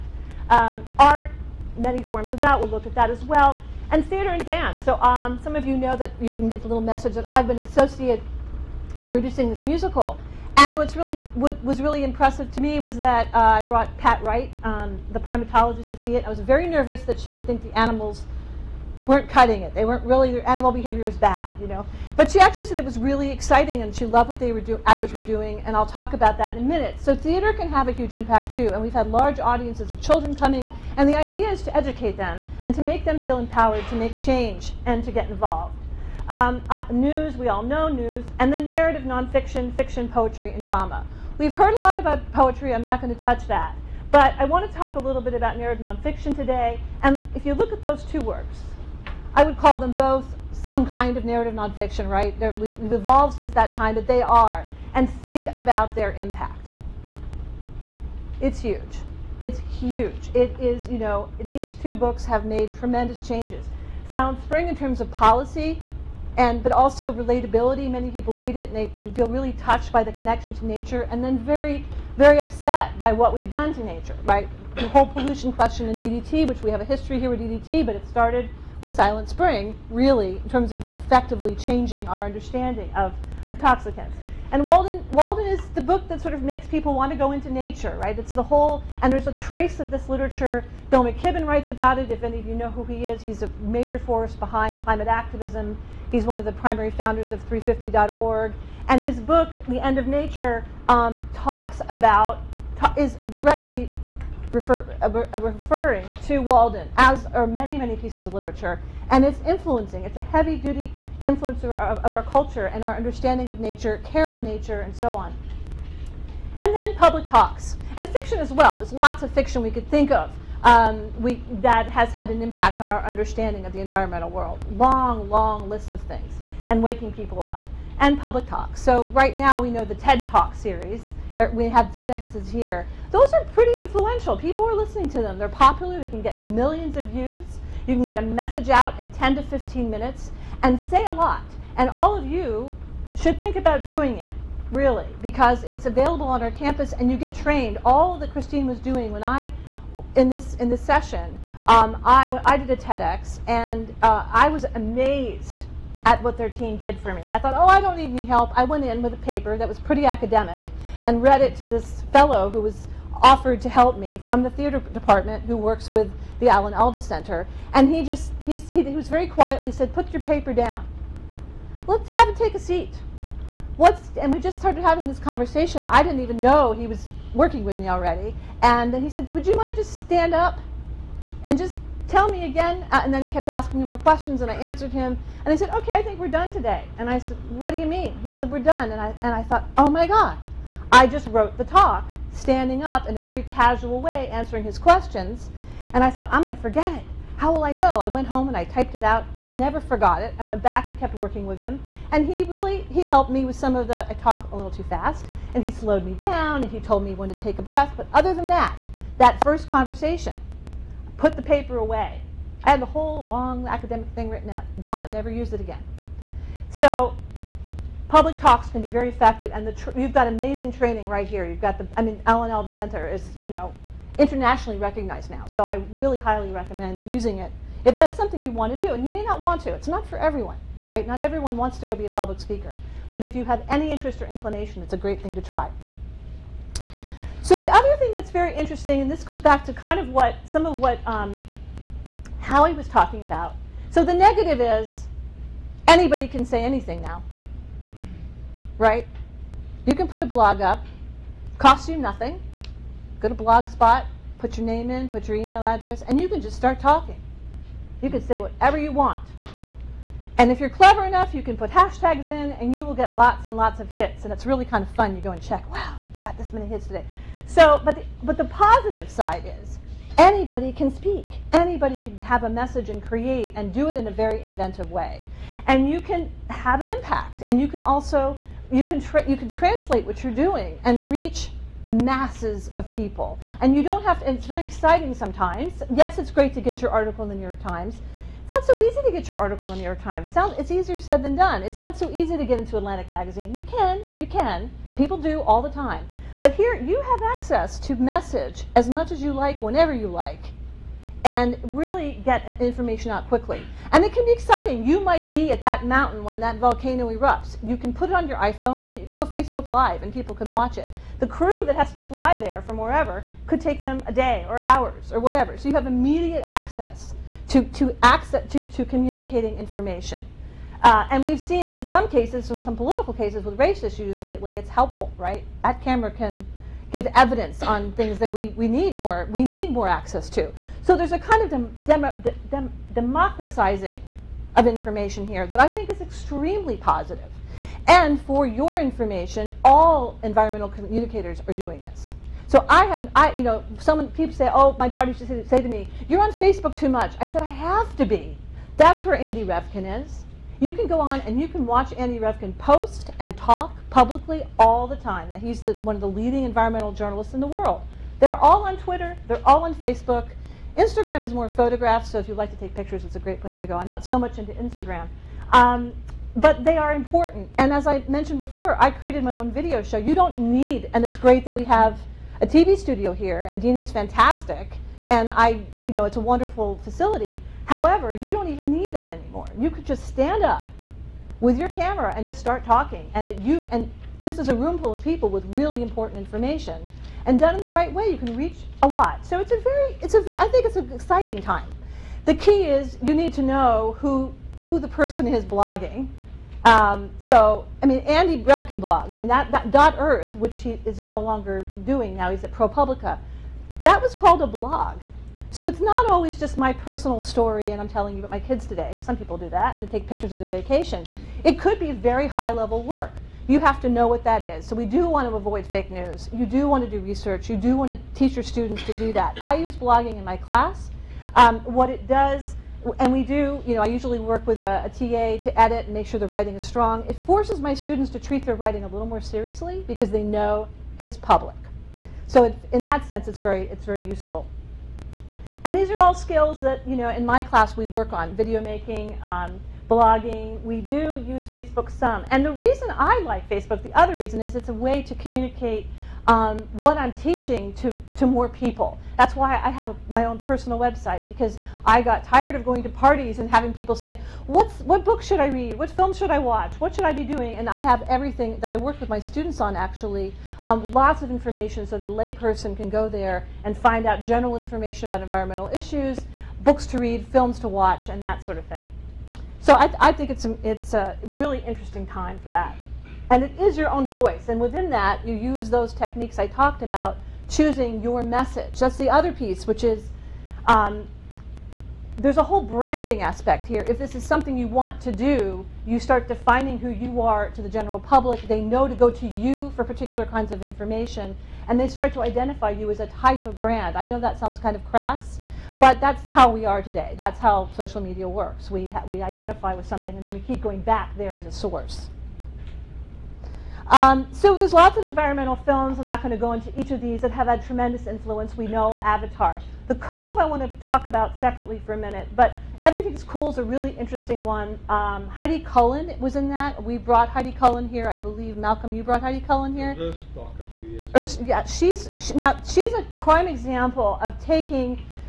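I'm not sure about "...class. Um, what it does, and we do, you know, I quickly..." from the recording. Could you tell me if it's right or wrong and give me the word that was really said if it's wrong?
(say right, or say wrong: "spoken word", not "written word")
wrong: "usually", not "quickly".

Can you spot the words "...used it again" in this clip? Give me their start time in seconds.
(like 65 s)
215 s.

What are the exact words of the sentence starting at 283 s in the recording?
And you don't have to, it's very exciting sometimes.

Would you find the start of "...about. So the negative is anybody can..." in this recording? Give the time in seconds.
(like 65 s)
243 s.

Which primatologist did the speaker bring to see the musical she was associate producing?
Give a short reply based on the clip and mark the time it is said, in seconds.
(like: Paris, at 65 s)
Pat Wright, at 13 s.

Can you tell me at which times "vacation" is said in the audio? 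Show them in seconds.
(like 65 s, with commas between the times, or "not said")
410 s.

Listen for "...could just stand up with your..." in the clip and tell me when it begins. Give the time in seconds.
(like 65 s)
379 s.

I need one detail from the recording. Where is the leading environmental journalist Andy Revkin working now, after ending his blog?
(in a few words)
ProPublica.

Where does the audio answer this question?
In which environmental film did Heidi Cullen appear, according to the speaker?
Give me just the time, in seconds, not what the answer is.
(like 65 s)
512 s.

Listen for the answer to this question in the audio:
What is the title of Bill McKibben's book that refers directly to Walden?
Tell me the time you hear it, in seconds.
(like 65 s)
99 s.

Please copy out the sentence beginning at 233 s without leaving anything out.
But if you have any interest or inclination, it's a great thing to try.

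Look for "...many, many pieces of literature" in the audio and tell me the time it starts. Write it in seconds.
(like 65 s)
107 s.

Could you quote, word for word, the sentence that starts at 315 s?
So you have immediate access to, to, access, to, to communicating information.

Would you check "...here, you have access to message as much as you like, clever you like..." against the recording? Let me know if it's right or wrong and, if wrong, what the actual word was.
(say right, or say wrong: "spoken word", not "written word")
wrong: "whenever", not "clever".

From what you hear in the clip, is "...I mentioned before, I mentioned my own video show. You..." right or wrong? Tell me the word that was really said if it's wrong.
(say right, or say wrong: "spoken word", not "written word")
wrong: "created", not "mentioned".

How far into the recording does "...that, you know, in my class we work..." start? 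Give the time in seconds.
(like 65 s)
436 s.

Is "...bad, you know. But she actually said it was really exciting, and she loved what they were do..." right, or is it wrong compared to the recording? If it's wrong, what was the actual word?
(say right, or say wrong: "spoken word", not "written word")
right.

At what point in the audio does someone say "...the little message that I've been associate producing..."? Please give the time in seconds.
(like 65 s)
6 s.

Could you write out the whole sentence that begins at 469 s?
So I, I think it's a, it's a really interesting time for that.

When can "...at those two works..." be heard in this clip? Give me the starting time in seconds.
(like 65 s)
47 s.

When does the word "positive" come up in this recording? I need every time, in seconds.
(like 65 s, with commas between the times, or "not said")
268 s, 336 s.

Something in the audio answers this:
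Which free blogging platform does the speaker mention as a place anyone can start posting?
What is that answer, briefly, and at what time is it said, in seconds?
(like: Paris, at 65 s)
Blogspot, at 253 s.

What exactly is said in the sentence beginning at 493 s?
I know that sounds kind of crass, but that's how we are today.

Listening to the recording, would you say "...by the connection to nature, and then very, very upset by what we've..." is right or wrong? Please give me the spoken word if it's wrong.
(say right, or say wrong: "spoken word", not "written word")
right.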